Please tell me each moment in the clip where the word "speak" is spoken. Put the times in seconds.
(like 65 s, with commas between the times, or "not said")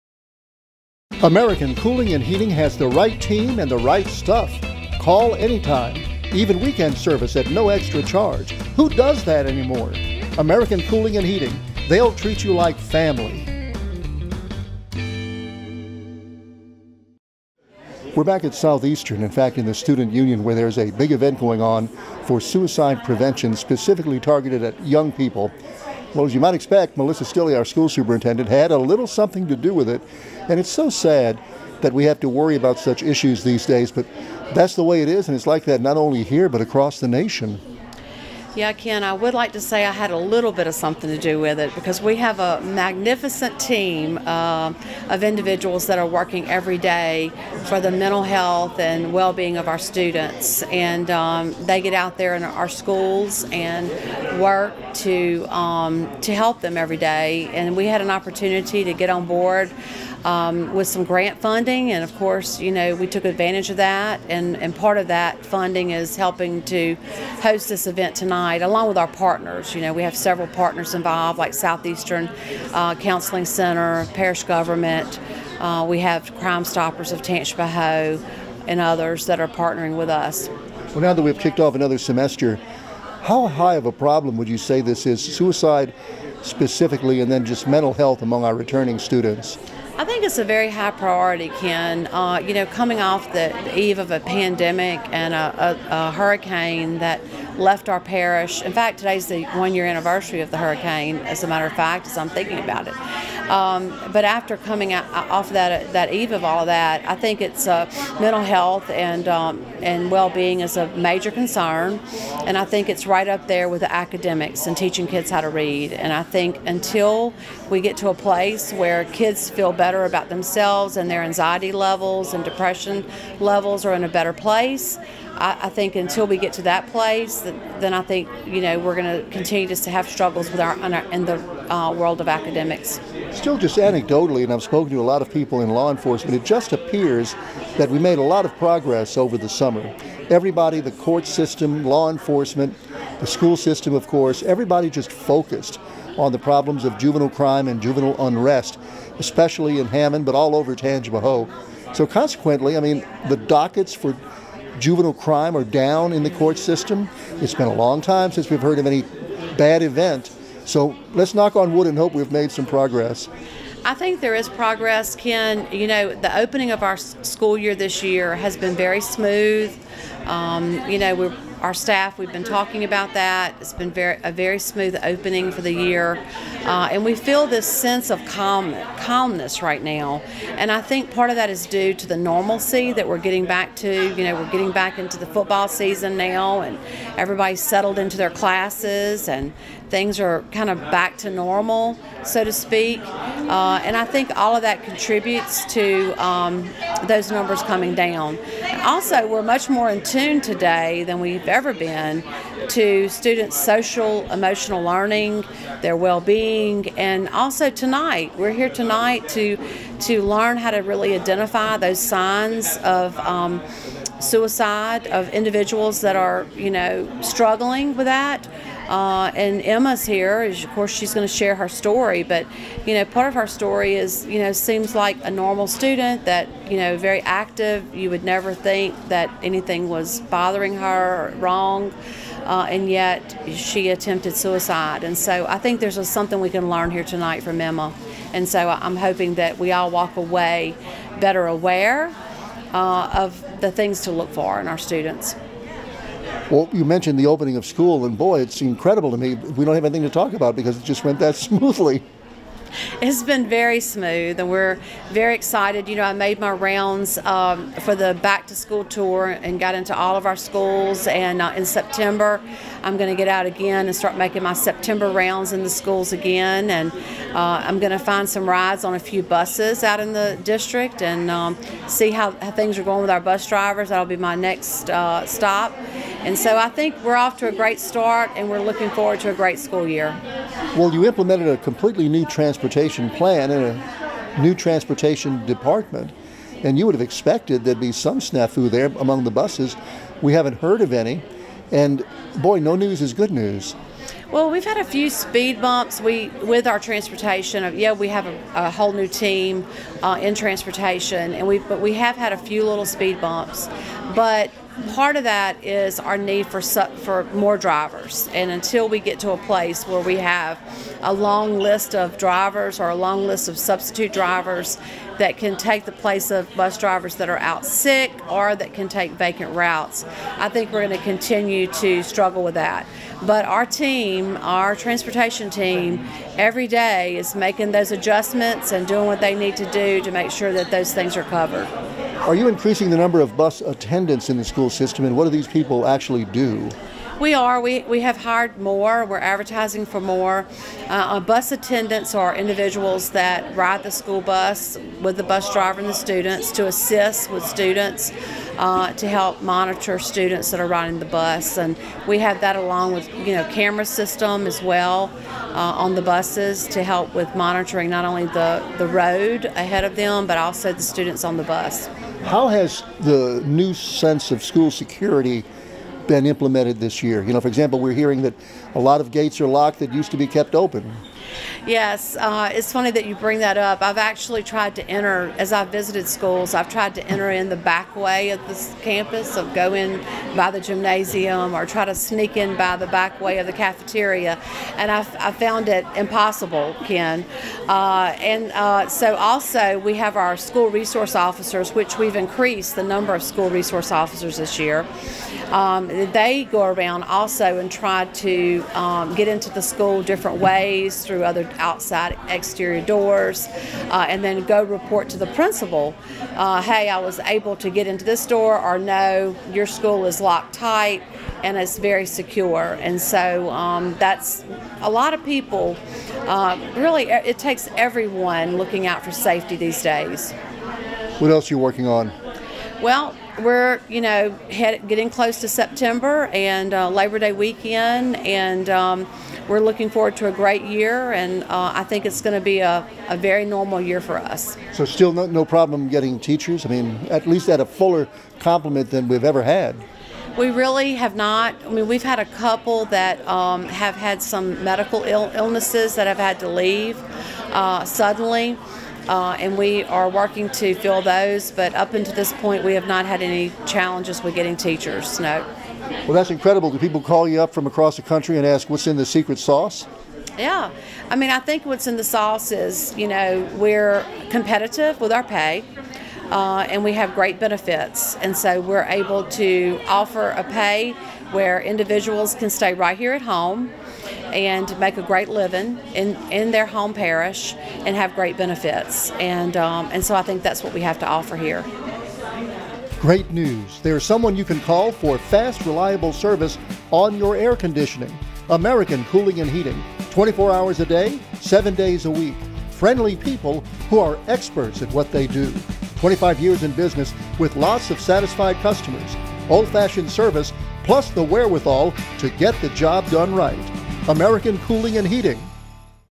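192 s.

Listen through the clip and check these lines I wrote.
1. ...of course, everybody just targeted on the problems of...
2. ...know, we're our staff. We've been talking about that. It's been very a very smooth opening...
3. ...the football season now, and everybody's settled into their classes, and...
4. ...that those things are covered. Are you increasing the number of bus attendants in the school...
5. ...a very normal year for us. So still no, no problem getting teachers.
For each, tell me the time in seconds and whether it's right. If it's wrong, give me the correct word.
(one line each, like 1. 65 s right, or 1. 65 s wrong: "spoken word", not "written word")
1. 143 s wrong: "focused", not "targeted"
2. 170 s right
3. 185 s right
4. 330 s right
5. 433 s right.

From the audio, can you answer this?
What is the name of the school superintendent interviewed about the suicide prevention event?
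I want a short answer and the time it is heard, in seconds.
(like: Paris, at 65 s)
Melissa Stilley, at 26 s.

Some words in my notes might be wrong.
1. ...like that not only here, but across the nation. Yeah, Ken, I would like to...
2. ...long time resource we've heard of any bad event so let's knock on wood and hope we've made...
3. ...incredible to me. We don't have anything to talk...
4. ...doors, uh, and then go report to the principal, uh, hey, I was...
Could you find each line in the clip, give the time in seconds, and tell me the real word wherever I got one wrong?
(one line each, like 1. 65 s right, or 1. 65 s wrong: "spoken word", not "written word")
1. 35 s right
2. 157 s wrong: "since", not "resource"
3. 248 s right
4. 402 s right.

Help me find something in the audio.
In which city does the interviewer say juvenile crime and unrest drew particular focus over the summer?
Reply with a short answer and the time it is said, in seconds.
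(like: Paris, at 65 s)
Hammond, at 149 s.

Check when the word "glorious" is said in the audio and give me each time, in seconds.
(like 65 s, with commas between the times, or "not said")
not said.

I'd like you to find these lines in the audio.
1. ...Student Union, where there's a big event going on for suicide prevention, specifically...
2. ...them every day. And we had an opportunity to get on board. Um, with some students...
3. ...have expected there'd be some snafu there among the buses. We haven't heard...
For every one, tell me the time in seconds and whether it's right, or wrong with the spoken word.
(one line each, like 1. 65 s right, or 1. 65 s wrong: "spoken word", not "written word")
1. 19 s right
2. 56 s wrong: "grant", not "students"
3. 286 s right.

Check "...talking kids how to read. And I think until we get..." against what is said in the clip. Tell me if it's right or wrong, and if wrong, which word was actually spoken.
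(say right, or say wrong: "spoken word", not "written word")
wrong: "teaching", not "talking".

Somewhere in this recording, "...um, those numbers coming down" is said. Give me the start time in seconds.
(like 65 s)
196 s.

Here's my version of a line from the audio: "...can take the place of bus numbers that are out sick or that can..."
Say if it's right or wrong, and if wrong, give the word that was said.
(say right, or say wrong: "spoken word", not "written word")
wrong: "drivers", not "numbers".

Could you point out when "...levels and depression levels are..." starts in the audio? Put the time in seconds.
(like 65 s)
121 s.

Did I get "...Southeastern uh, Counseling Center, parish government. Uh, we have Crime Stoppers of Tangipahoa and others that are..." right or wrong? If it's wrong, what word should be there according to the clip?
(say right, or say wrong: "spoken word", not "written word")
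right.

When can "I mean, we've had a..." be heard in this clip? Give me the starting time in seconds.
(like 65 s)
441 s.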